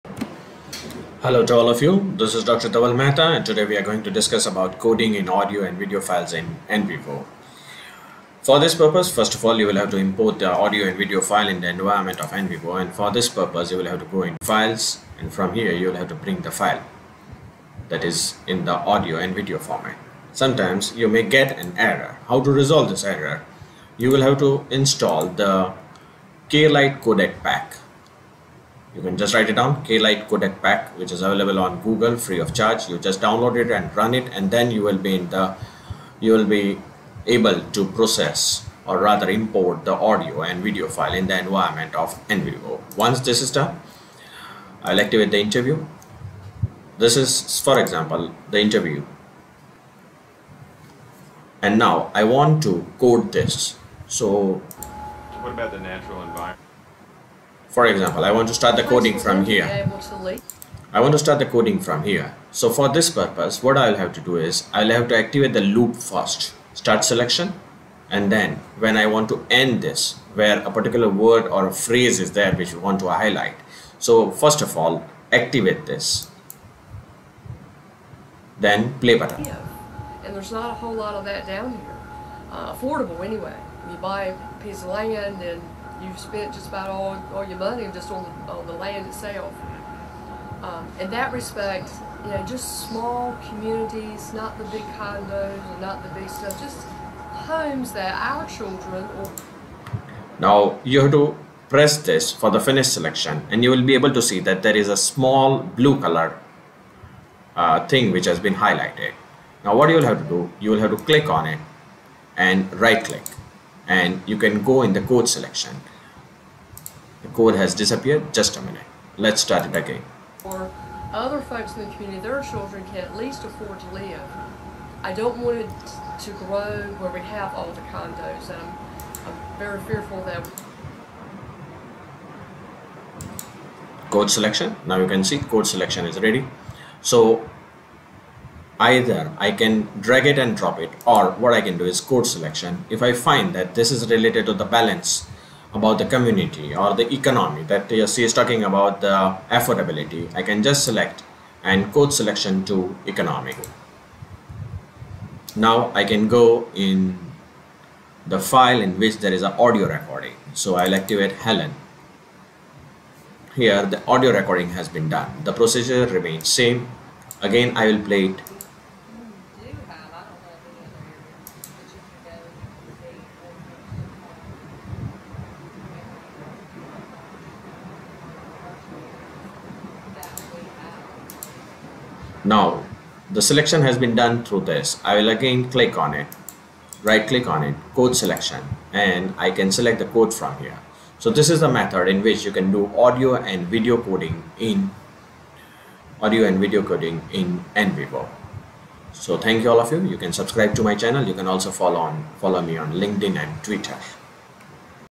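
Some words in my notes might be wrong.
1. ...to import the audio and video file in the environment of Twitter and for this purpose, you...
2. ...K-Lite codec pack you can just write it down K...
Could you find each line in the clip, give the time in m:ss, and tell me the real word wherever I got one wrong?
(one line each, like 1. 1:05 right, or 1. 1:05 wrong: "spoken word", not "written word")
1. 0:09 wrong: "NVivo", not "Twitter"
2. 0:26 right.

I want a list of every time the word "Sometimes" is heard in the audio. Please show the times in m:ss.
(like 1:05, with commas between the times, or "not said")
0:20.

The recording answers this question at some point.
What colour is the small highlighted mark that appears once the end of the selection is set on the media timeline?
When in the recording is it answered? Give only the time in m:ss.
1:45.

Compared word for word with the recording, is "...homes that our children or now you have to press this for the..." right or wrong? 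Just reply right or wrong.
right.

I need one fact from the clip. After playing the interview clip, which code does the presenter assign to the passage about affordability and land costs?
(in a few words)
economic.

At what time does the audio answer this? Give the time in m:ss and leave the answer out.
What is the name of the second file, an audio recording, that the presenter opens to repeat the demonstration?
2:41.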